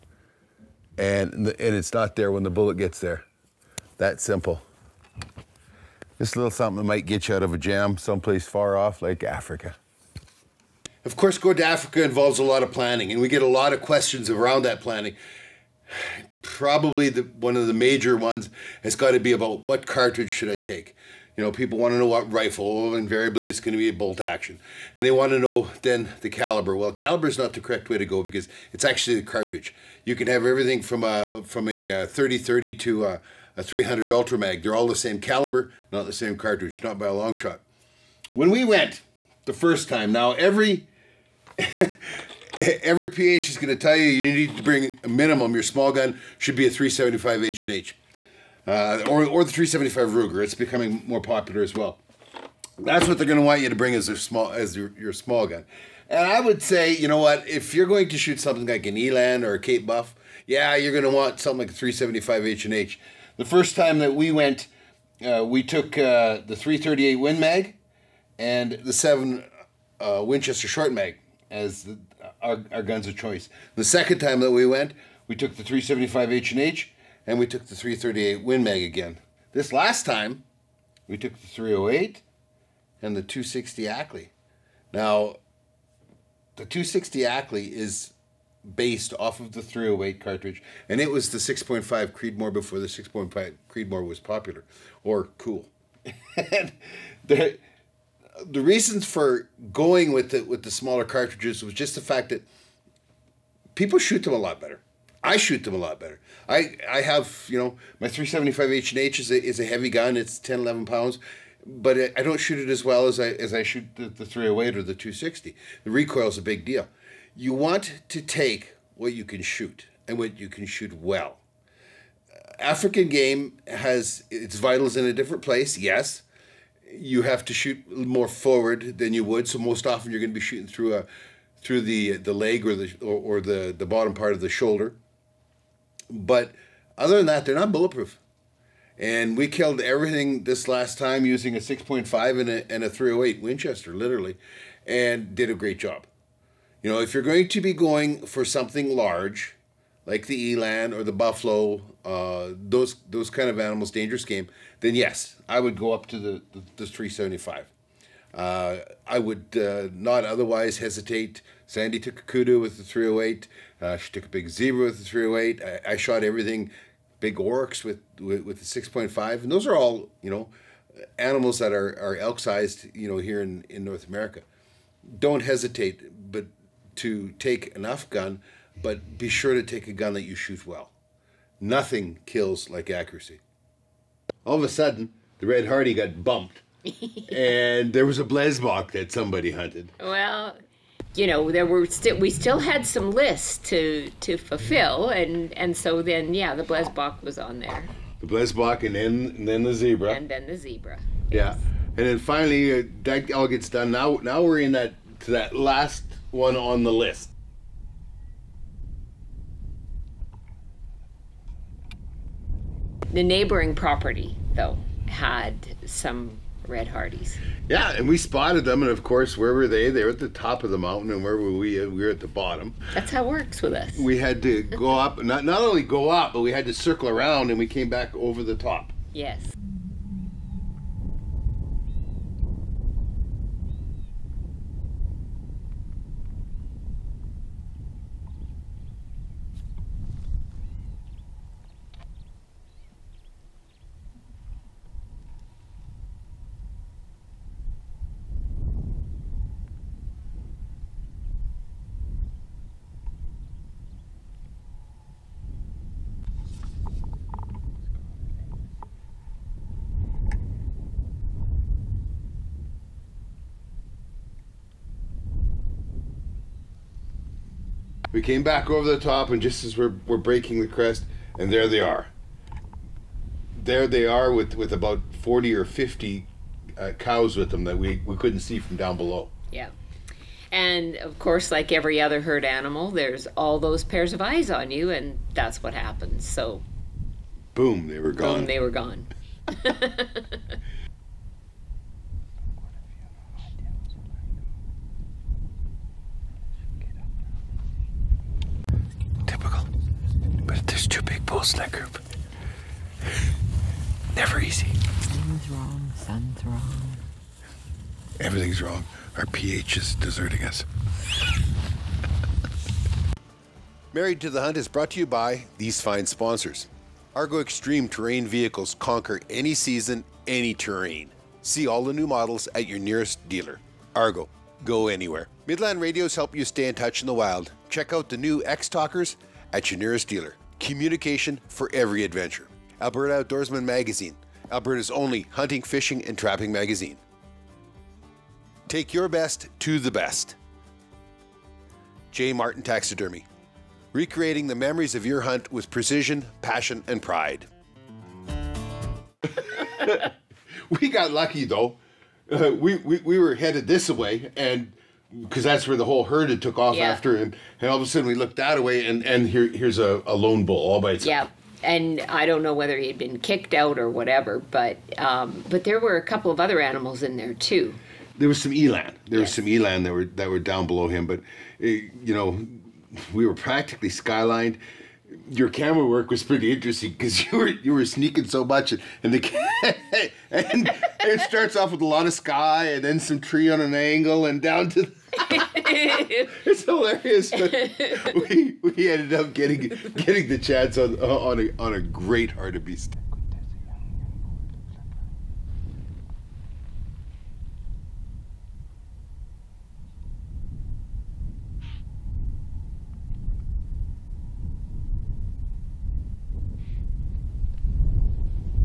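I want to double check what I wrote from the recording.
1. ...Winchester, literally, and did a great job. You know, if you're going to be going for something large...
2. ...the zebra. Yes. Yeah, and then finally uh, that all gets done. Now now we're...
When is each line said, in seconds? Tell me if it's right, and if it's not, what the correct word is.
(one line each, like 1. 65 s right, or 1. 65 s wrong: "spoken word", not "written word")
1. 143 s right
2. 200 s right.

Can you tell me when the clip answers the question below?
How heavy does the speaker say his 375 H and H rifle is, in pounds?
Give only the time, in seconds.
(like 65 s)
110 s.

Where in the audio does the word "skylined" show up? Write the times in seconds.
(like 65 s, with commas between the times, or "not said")
373 s.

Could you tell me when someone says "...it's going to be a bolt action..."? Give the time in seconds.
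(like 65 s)
23 s.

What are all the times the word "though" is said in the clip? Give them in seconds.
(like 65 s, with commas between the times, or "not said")
214 s, 351 s.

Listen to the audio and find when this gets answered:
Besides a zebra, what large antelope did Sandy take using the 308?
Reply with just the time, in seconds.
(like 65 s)
162 s.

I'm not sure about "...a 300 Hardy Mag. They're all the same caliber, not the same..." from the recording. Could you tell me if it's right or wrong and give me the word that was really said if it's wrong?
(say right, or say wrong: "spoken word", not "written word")
wrong: "Ultra", not "Hardy".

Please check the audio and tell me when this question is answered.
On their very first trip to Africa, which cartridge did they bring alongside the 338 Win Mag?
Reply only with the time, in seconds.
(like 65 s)
68 s.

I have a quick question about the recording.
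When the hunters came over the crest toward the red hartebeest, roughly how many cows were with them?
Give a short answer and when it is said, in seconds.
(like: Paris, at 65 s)
40 or 50, at 275 s.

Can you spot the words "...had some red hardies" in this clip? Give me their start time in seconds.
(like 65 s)
215 s.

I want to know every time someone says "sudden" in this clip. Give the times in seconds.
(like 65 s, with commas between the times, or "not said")
184 s, 357 s.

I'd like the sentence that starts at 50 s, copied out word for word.
It's becoming more popular as well.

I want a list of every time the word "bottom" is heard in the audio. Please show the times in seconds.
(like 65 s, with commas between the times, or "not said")
133 s, 222 s.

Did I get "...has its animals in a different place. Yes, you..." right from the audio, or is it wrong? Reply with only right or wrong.
wrong.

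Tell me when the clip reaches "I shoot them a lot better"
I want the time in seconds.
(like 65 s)
105 s.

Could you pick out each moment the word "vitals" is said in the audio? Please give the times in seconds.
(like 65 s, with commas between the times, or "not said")
124 s.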